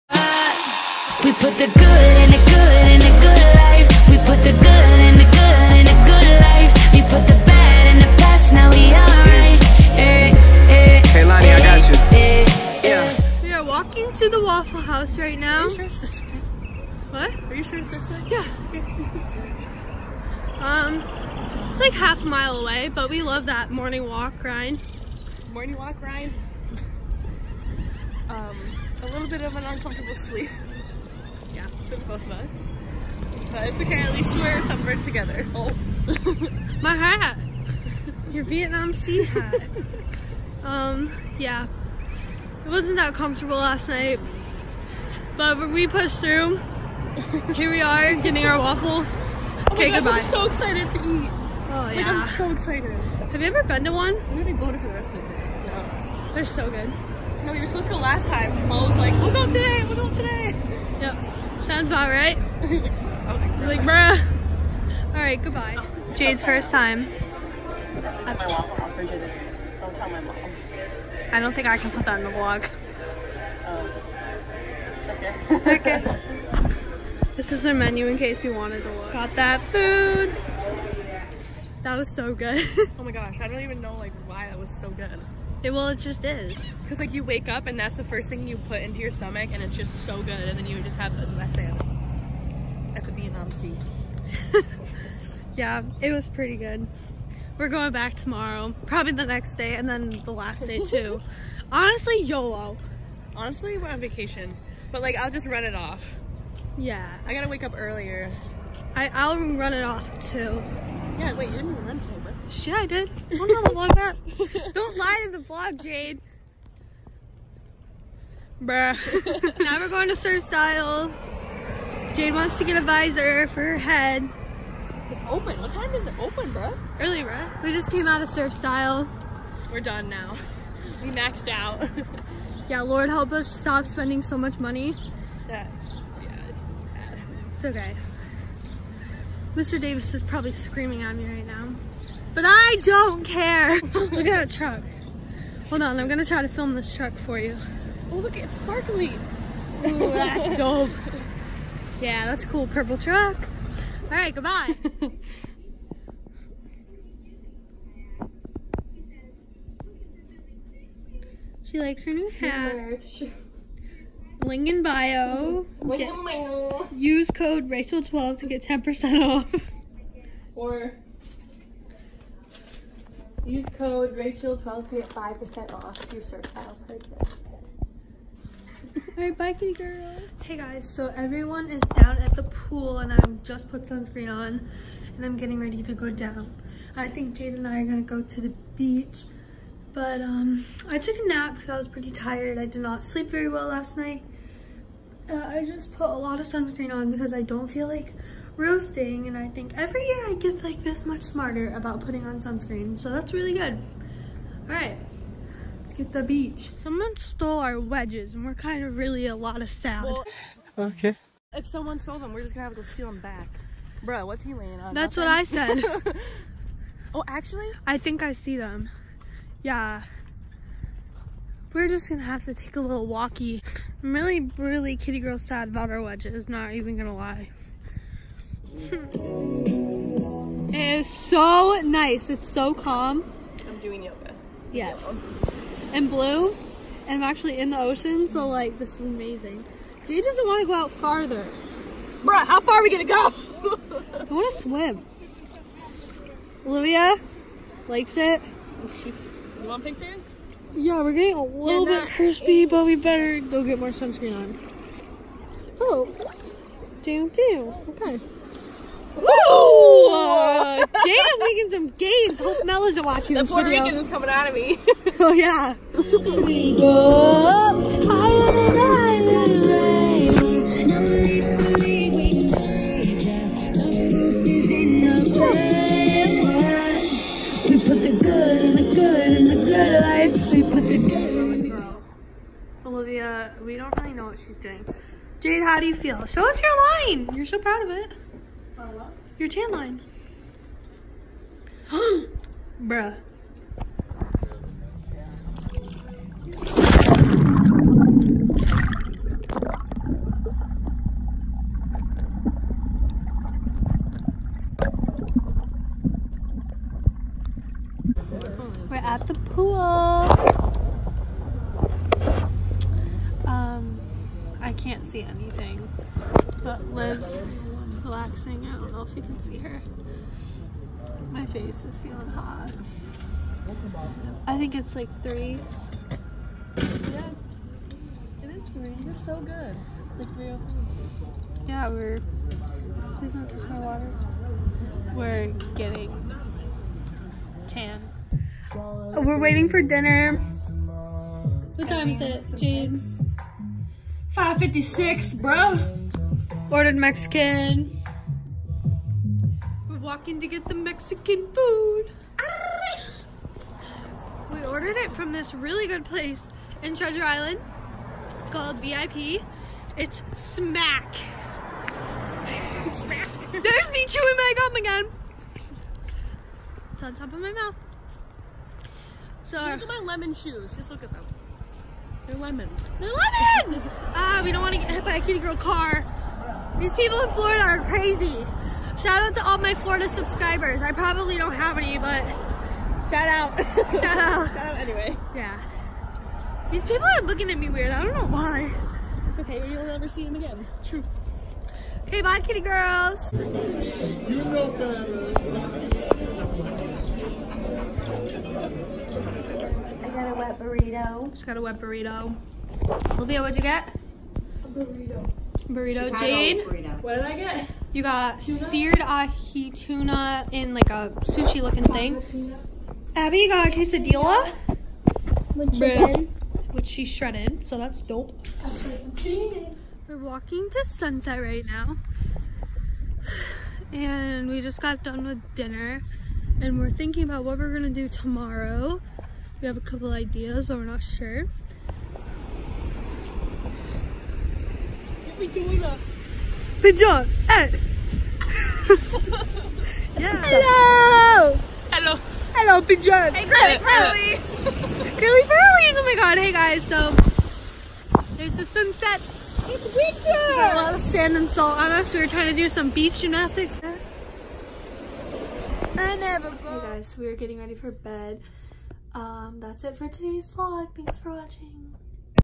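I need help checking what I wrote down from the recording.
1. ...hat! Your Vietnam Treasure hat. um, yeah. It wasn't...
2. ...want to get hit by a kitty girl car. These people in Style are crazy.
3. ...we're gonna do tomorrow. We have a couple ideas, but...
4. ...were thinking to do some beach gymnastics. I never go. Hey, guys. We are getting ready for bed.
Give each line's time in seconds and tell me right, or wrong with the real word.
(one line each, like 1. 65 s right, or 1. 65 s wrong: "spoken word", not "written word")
1. 36 s wrong: "Sea", not "Treasure"
2. 374 s wrong: "Florida", not "Style"
3. 427 s right
4. 452 s wrong: "trying", not "thinking".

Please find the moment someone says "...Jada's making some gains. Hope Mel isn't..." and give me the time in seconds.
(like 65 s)
260 s.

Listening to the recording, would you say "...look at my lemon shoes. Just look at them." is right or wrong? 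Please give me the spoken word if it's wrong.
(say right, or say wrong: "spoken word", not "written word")
right.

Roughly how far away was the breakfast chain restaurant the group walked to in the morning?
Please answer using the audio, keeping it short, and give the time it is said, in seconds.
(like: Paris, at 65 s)
half a mile, at 21 s.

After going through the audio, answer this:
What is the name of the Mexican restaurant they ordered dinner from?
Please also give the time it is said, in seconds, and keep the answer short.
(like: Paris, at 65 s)
VIP, at 358 s.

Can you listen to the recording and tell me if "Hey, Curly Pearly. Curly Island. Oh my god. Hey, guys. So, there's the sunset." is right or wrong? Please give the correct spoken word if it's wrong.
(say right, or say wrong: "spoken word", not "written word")
wrong: "Pearlies", not "Island".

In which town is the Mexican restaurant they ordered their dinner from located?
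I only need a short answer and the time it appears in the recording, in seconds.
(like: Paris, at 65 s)
Treasure Island, at 356 s.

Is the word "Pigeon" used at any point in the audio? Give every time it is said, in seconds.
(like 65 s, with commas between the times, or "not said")
442 s.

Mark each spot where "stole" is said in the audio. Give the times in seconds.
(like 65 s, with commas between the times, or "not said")
207 s, 211 s.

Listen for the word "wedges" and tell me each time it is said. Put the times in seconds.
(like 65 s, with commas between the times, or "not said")
207 s, 226 s.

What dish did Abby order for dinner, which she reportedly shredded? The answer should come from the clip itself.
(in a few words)
quesadilla.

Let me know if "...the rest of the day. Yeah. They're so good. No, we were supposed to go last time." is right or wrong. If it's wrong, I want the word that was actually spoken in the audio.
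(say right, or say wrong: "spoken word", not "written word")
right.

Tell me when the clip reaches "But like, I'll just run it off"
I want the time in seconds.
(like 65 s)
104 s.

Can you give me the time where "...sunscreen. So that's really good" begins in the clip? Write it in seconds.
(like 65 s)
202 s.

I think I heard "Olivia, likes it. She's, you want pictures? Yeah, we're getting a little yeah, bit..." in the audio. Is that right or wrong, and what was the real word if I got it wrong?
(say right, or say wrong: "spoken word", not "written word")
right.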